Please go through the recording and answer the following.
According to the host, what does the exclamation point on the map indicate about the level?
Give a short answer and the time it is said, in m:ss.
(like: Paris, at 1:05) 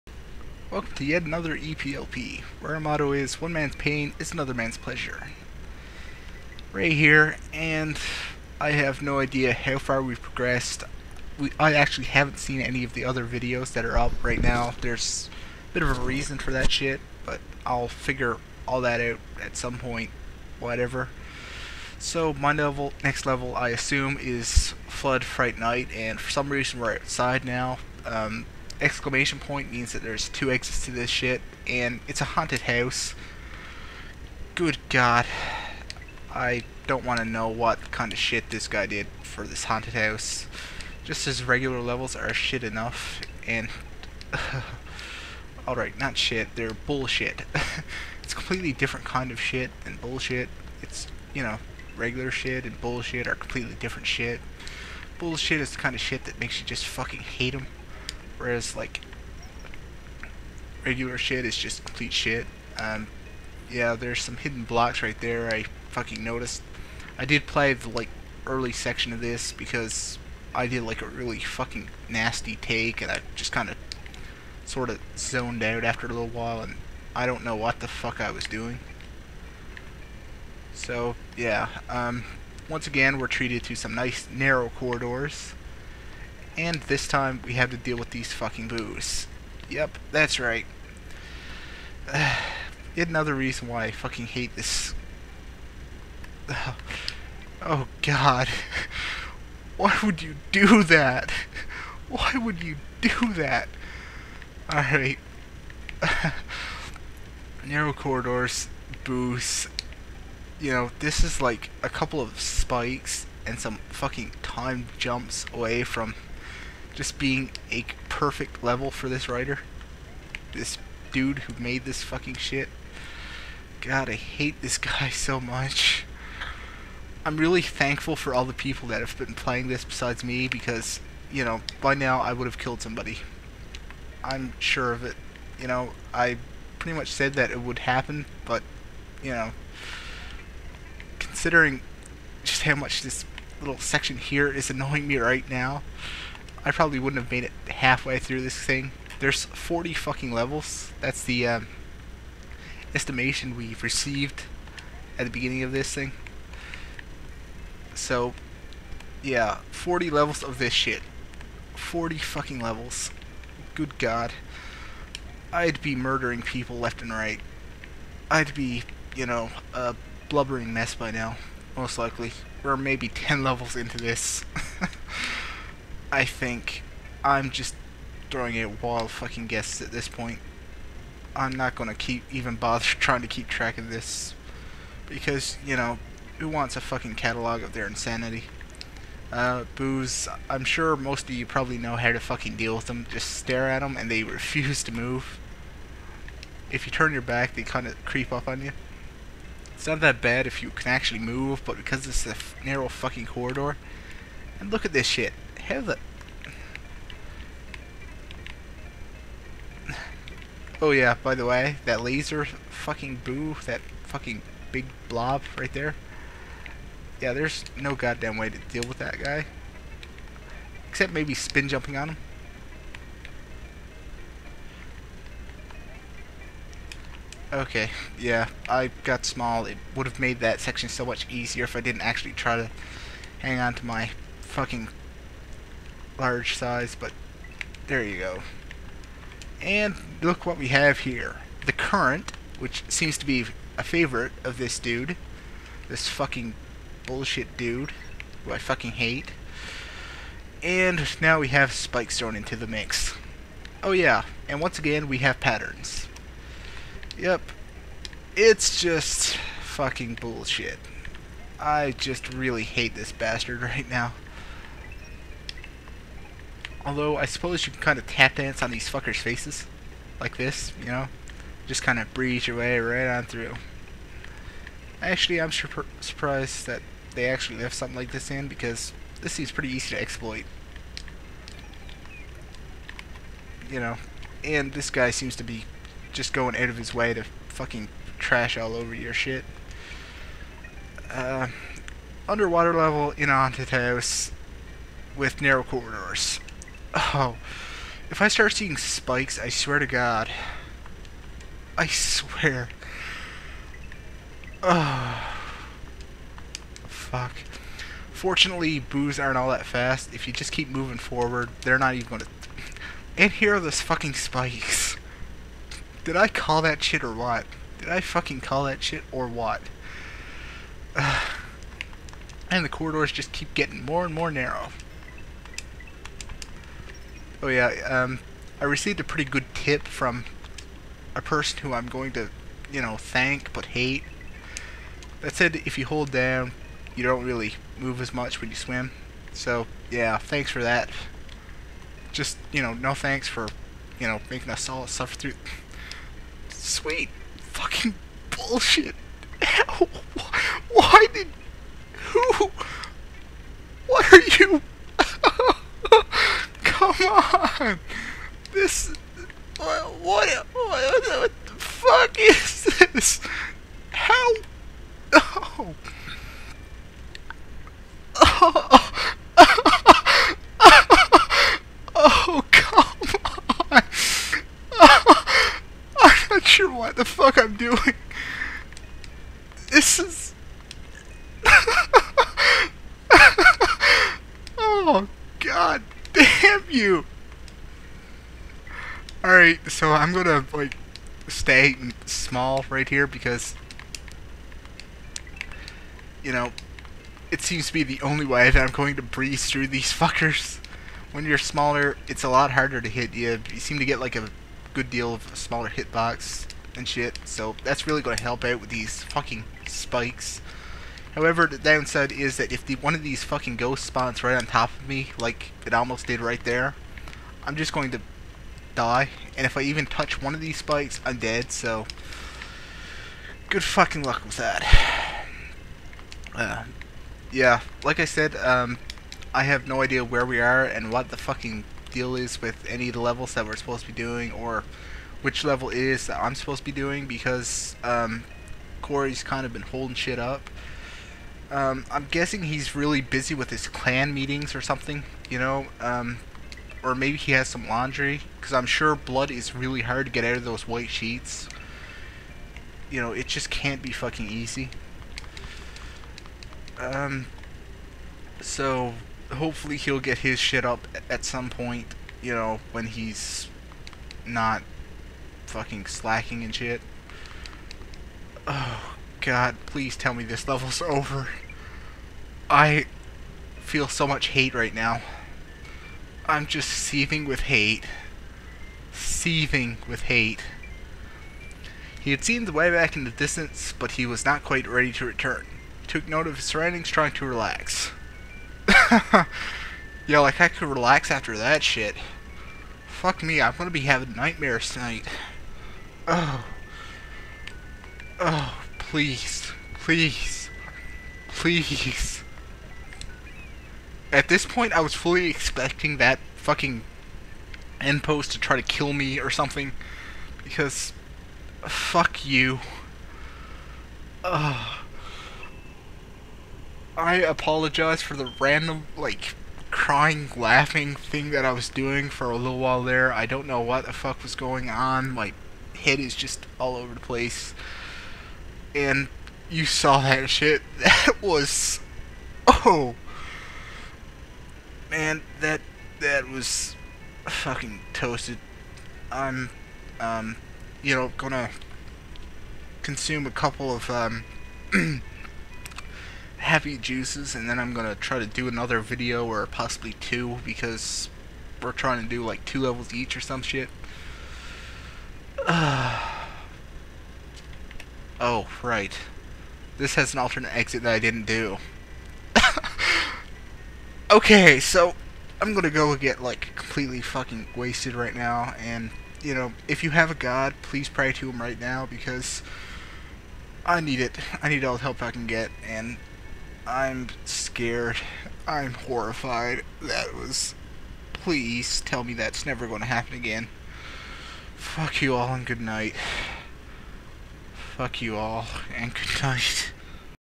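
two exits, at 0:30.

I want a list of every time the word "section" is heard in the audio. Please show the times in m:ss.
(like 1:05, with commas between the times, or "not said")
1:08, 2:23, 3:50.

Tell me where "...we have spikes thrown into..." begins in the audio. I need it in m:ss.
4:11.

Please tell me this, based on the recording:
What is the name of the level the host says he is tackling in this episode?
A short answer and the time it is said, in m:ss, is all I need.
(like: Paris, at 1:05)
Flood Fright Night, at 0:24.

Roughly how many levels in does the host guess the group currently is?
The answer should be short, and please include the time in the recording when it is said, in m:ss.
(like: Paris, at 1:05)
10, at 2:53.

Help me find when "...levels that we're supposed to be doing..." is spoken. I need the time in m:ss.
7:13.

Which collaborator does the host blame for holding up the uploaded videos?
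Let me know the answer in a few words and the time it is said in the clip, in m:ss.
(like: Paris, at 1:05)
Corey, at 7:18.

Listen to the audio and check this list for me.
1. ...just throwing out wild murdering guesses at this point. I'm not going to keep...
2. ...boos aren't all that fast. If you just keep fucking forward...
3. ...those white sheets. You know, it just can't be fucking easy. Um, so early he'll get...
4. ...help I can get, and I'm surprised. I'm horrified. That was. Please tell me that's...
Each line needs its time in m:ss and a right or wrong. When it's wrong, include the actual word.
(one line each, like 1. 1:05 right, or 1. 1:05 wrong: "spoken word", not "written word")
1. 2:57 wrong: "fucking", not "murdering"
2. 5:08 wrong: "moving", not "fucking"
3. 7:30 wrong: "hopefully", not "early"
4. 9:34 wrong: "scared", not "surprised".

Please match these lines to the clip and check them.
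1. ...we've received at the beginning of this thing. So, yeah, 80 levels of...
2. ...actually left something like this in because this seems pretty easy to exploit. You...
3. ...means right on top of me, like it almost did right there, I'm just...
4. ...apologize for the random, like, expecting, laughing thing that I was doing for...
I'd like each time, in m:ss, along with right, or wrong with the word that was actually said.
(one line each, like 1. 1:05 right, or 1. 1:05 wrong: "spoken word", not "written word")
1. 2:33 wrong: "40", not "80"
2. 4:37 right
3. 6:53 wrong: "spawns", not "means"
4. 8:37 wrong: "crying", not "expecting".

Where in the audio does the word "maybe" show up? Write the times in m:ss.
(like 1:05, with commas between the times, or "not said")
2:52, 3:41, 7:26.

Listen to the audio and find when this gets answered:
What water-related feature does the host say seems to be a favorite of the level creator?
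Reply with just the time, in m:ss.
4:01.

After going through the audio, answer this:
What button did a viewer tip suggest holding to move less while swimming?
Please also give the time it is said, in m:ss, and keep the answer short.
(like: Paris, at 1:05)
down, at 5:35.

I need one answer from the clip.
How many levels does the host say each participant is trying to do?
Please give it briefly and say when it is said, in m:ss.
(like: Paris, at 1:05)
2, at 9:12.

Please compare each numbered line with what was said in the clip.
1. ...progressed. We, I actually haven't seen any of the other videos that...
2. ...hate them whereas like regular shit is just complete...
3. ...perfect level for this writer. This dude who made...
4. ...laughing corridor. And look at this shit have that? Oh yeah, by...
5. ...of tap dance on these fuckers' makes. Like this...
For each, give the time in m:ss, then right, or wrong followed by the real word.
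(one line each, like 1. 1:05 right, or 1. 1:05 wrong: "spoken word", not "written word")
1. 0:10 right
2. 0:57 right
3. 1:58 right
4. 3:22 wrong: "fucking", not "laughing"
5. 4:27 wrong: "faces", not "makes".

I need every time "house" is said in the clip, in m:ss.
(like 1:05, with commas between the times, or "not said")
0:32, 0:39, 4:53.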